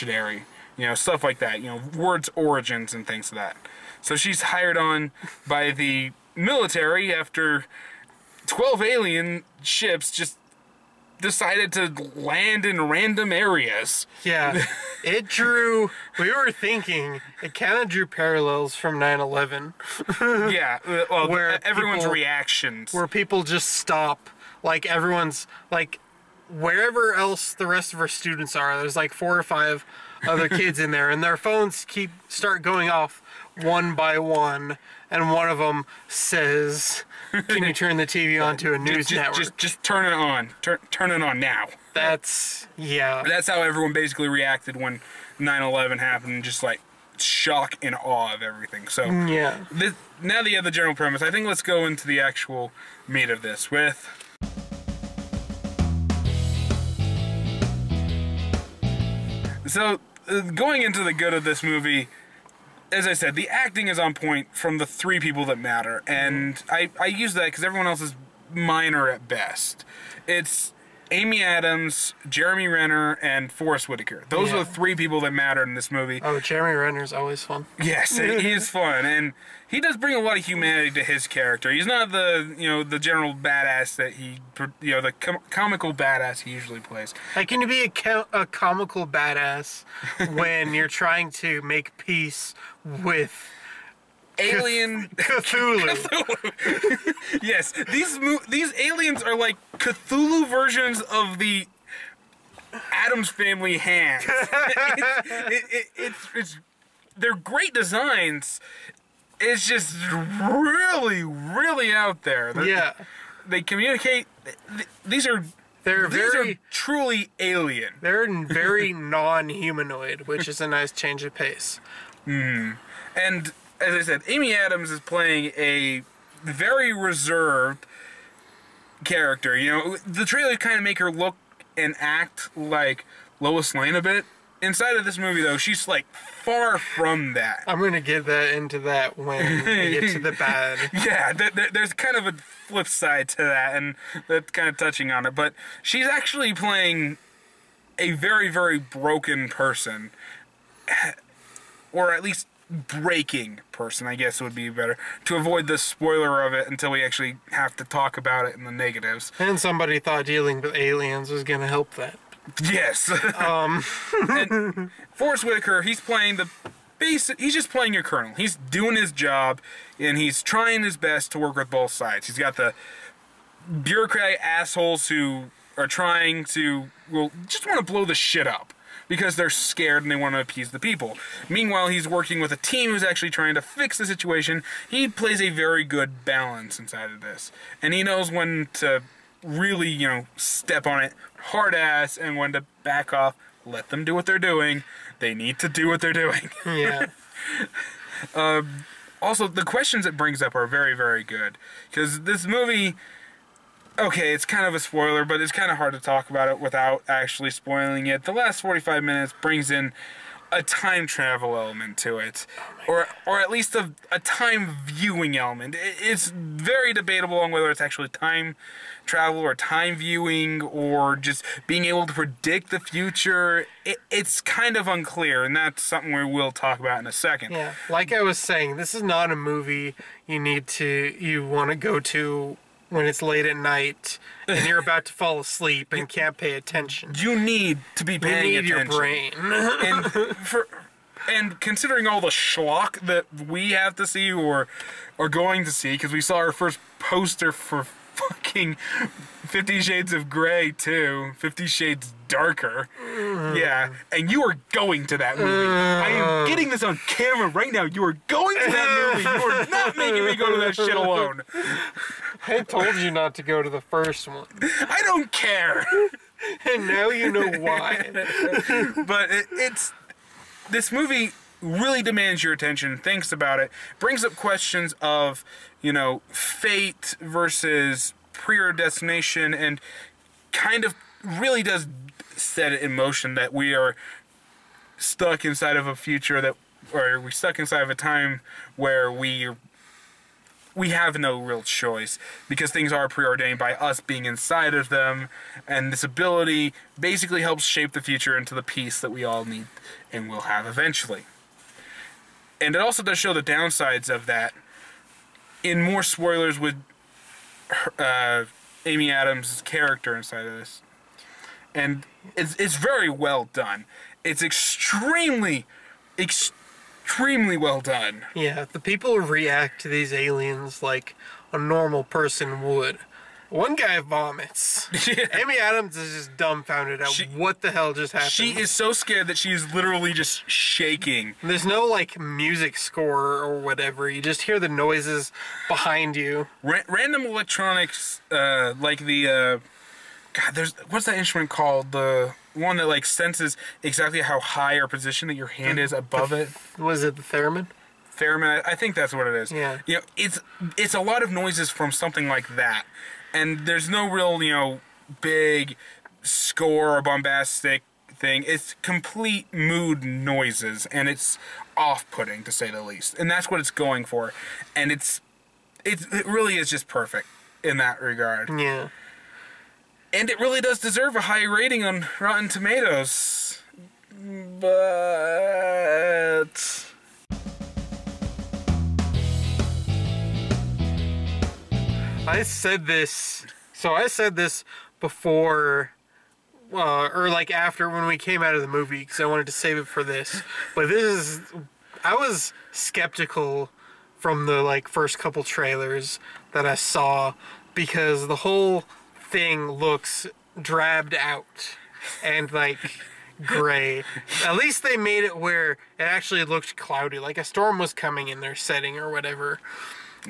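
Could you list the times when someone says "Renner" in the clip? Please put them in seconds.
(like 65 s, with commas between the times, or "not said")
72 s, 76 s.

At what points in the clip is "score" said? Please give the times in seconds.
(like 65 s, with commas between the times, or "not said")
332 s, 356 s.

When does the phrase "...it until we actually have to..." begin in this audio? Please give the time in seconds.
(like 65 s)
156 s.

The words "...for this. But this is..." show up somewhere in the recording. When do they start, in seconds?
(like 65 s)
389 s.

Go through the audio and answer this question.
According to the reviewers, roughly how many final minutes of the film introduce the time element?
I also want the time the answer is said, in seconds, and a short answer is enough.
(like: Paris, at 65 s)
45, at 208 s.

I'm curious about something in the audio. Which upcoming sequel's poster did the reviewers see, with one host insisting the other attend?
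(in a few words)
Fifty Shades Darker.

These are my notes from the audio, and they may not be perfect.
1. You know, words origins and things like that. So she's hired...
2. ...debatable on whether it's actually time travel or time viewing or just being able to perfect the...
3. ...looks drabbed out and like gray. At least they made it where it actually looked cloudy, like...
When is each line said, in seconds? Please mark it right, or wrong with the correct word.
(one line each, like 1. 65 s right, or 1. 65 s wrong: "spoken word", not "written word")
1. 1 s right
2. 216 s wrong: "predict", not "perfect"
3. 399 s right.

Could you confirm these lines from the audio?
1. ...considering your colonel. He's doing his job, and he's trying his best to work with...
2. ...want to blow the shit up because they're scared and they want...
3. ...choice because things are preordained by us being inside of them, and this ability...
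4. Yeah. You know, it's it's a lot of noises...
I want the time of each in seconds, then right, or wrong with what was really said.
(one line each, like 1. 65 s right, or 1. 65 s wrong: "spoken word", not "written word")
1. 167 s wrong: "playing", not "considering"
2. 177 s right
3. 291 s right
4. 349 s right.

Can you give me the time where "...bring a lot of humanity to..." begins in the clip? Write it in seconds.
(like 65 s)
79 s.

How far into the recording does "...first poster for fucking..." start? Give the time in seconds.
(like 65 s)
246 s.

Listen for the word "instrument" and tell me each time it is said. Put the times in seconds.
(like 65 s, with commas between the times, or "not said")
341 s.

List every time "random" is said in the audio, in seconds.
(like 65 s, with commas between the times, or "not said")
12 s, 336 s.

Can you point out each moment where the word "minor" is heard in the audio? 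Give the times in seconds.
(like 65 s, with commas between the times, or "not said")
68 s.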